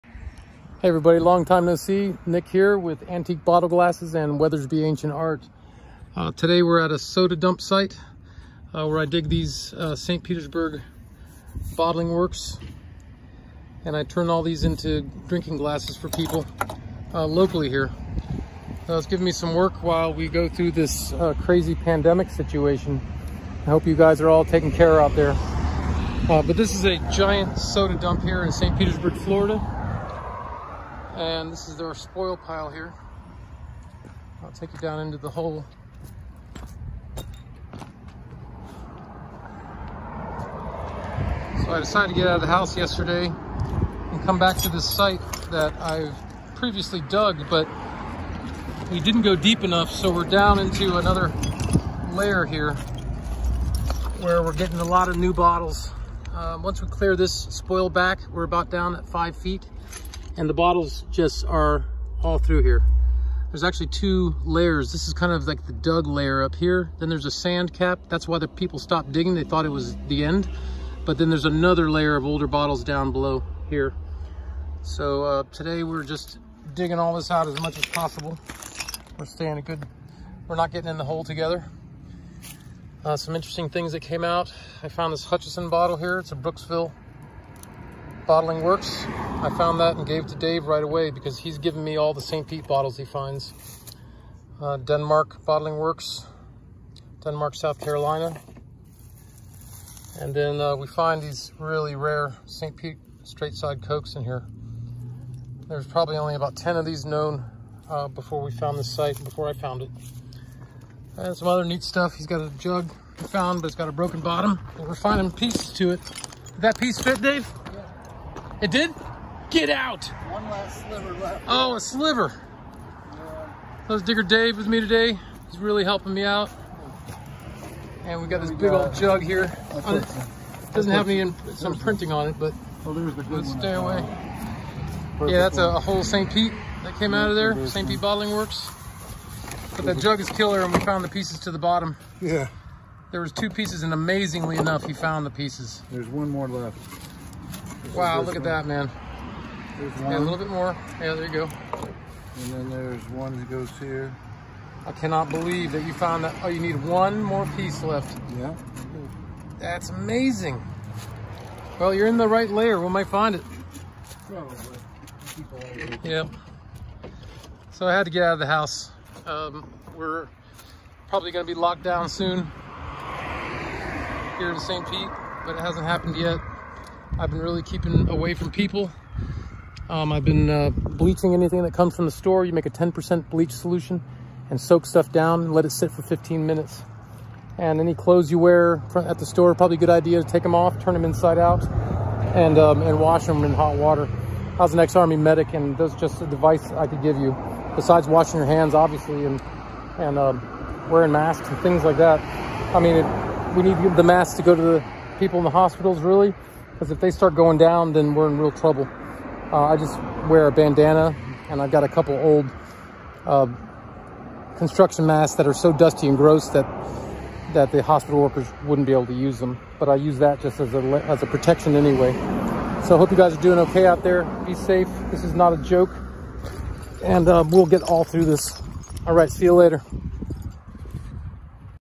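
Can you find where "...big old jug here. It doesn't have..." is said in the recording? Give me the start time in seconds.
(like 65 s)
128 s.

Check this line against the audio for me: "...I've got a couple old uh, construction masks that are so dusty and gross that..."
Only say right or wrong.
right.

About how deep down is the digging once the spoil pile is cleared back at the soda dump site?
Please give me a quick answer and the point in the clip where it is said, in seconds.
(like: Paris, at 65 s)
5 feet, at 59 s.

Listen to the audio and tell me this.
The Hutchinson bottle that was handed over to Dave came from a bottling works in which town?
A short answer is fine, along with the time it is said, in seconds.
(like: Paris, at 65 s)
Brooksville, at 86 s.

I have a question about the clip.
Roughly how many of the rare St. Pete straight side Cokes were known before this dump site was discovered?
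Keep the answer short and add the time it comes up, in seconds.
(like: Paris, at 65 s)
10, at 106 s.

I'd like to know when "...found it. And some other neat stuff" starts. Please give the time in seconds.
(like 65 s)
109 s.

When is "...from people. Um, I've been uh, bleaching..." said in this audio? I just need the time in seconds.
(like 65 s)
178 s.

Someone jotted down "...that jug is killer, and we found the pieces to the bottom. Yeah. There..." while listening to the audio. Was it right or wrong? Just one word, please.
right.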